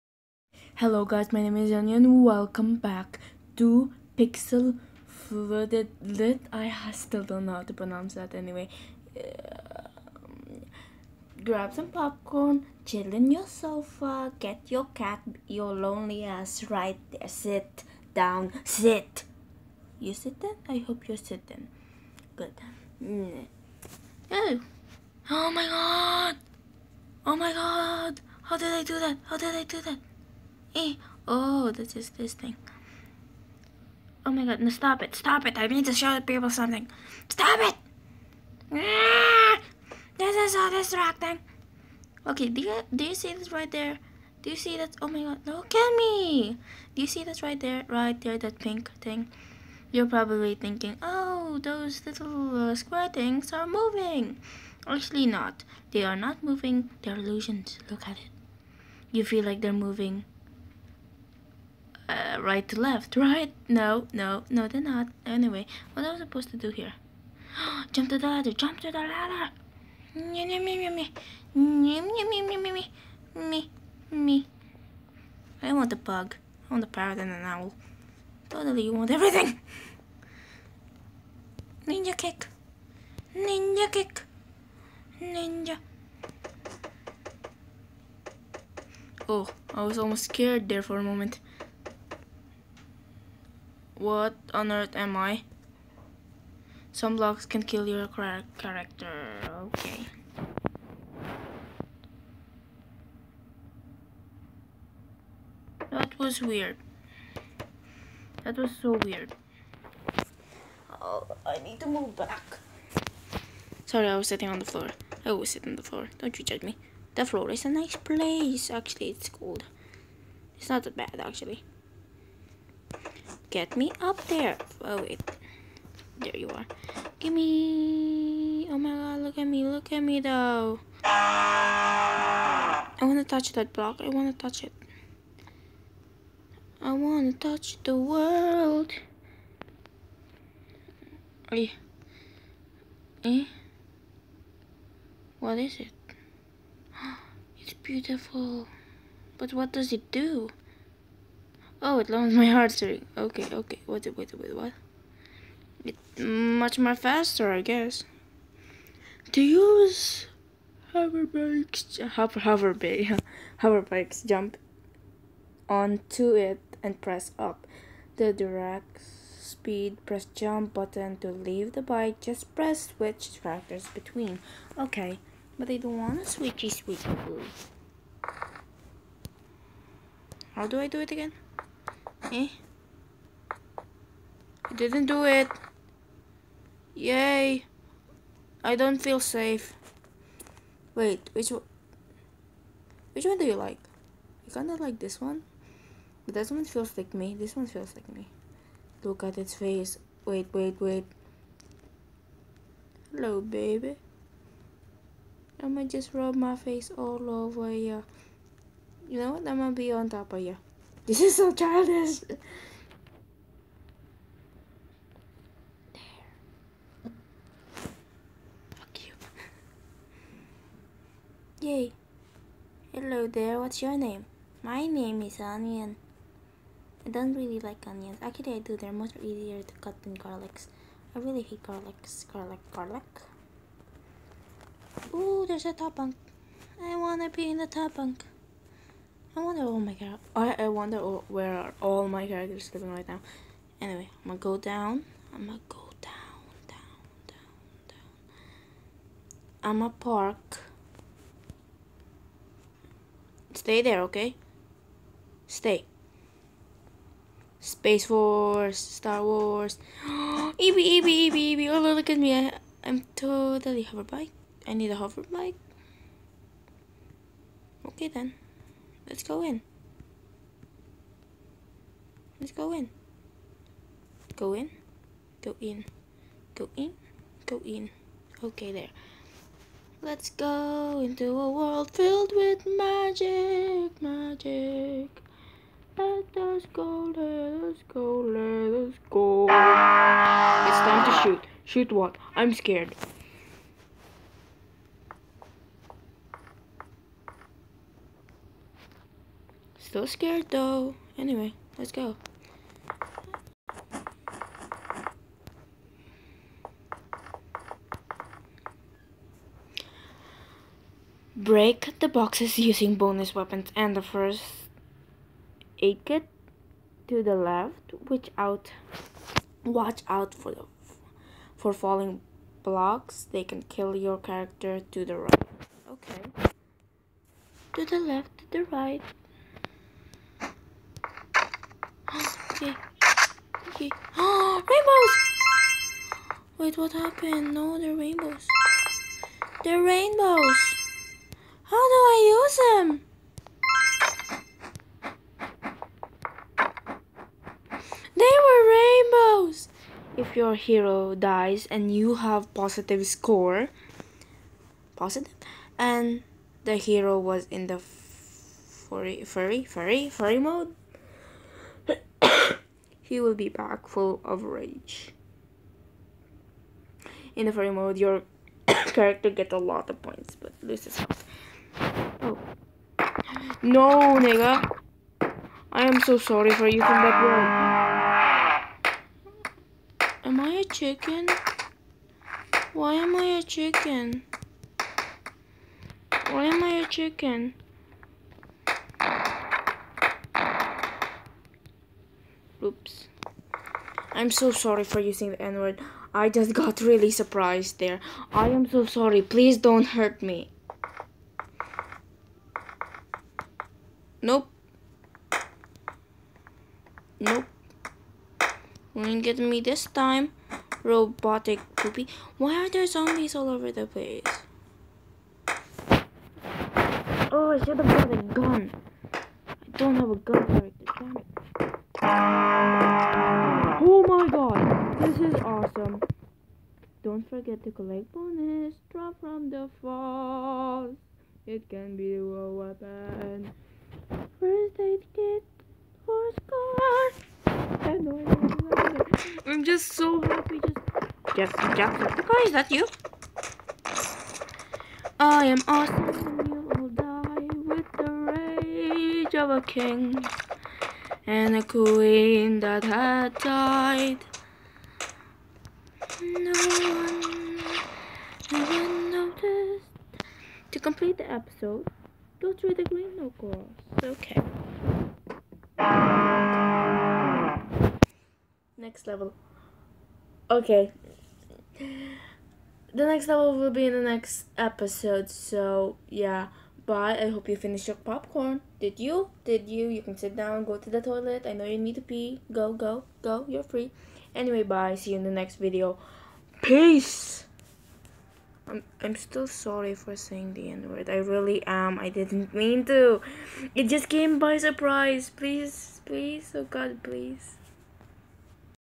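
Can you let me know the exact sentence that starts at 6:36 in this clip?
I just got really surprised there.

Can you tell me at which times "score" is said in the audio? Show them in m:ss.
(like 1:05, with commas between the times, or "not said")
5:53, 7:16.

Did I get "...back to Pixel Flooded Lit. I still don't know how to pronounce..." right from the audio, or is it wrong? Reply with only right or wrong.
right.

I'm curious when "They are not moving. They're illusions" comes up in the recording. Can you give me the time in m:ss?
0:55.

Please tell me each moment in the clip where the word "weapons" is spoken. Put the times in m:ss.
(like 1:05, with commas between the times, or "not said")
5:13, 7:12.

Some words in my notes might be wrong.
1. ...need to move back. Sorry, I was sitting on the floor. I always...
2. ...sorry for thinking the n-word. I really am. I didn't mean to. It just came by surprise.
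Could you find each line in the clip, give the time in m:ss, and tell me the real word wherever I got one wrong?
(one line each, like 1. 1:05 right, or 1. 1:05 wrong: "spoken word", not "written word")
1. 1:51 right
2. 8:09 wrong: "saying", not "thinking".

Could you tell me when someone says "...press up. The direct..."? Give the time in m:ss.
2:47.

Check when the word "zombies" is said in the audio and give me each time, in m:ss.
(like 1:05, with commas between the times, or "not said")
6:52.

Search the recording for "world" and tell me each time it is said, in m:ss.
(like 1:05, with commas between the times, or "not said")
2:17, 4:41.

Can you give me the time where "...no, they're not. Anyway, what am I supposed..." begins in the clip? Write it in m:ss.
1:04.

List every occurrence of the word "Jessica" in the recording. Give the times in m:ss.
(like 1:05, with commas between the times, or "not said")
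7:21.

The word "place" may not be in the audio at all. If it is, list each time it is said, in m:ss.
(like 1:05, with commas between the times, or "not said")
1:57, 6:53.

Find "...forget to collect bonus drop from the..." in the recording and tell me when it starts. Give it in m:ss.
7:07.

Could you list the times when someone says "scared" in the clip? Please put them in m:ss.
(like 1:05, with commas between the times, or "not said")
1:30, 4:52, 5:00.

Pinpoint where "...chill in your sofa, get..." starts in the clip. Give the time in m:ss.
0:12.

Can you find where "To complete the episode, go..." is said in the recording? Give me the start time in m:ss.
7:40.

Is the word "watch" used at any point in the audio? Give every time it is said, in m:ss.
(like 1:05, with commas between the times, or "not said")
5:19.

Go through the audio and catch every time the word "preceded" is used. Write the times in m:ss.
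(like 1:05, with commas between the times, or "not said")
not said.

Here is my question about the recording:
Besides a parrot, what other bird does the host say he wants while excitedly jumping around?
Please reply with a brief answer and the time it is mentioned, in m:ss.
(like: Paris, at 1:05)
An owl, at 1:17.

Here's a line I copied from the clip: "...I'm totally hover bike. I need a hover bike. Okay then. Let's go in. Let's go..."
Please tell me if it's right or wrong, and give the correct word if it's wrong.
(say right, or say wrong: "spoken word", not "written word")
right.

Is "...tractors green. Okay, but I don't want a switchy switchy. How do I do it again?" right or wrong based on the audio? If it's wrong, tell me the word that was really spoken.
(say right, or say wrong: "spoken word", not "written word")
wrong: "between", not "green".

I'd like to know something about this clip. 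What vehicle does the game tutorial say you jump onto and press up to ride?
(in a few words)
Hoverbike.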